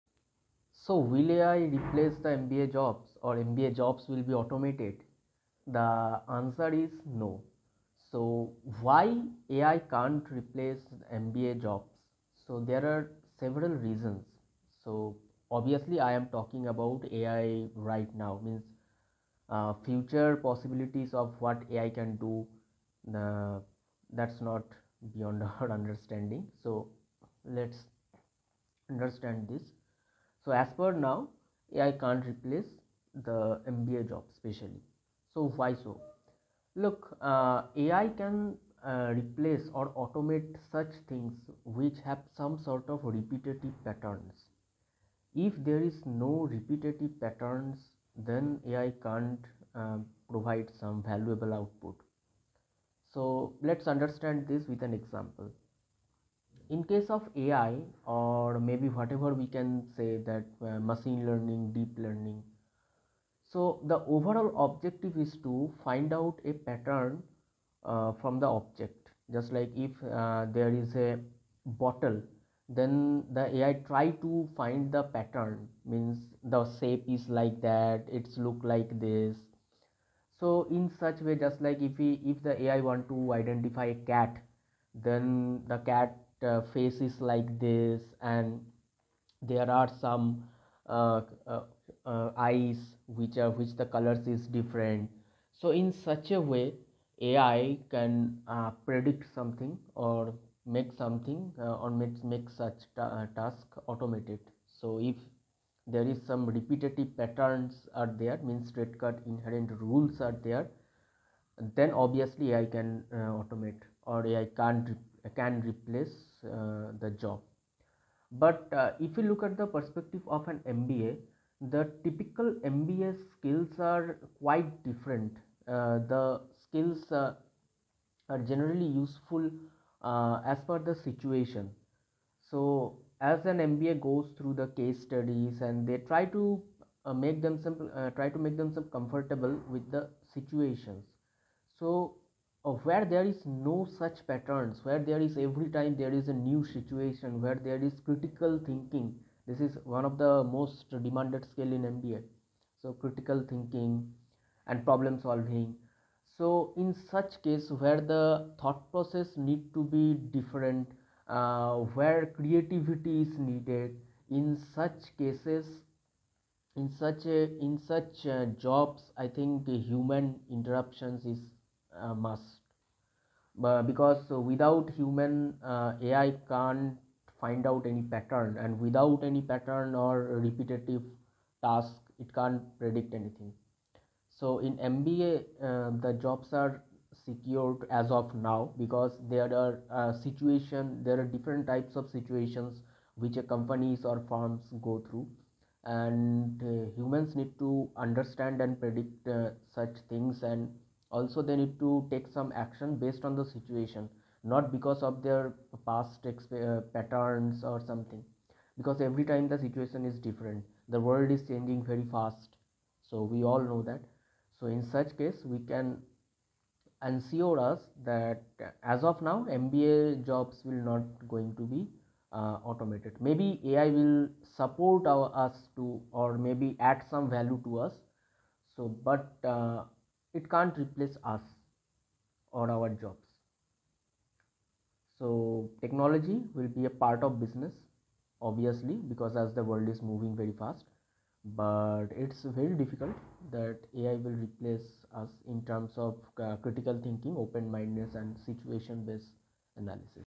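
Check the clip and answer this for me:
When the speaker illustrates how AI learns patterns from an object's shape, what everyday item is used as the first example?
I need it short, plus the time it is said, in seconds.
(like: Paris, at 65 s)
bottle, at 71 s.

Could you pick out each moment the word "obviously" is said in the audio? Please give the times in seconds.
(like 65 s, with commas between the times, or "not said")
15 s, 111 s, 238 s.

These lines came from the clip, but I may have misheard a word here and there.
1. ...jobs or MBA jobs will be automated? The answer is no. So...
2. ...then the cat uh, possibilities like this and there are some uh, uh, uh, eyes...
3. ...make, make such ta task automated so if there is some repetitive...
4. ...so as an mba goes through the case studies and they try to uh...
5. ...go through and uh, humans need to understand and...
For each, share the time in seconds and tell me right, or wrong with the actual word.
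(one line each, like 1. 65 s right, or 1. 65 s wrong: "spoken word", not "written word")
1. 2 s right
2. 85 s wrong: "faces", not "possibilities"
3. 101 s right
4. 132 s right
5. 194 s right.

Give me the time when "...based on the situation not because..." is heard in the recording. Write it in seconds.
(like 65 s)
203 s.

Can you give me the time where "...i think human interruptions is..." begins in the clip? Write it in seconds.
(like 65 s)
169 s.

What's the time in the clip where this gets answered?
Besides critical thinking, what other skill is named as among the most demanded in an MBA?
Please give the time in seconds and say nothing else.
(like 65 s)
154 s.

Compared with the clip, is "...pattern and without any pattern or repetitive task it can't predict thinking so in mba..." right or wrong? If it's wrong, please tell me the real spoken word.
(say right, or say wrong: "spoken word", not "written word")
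wrong: "anything", not "thinking".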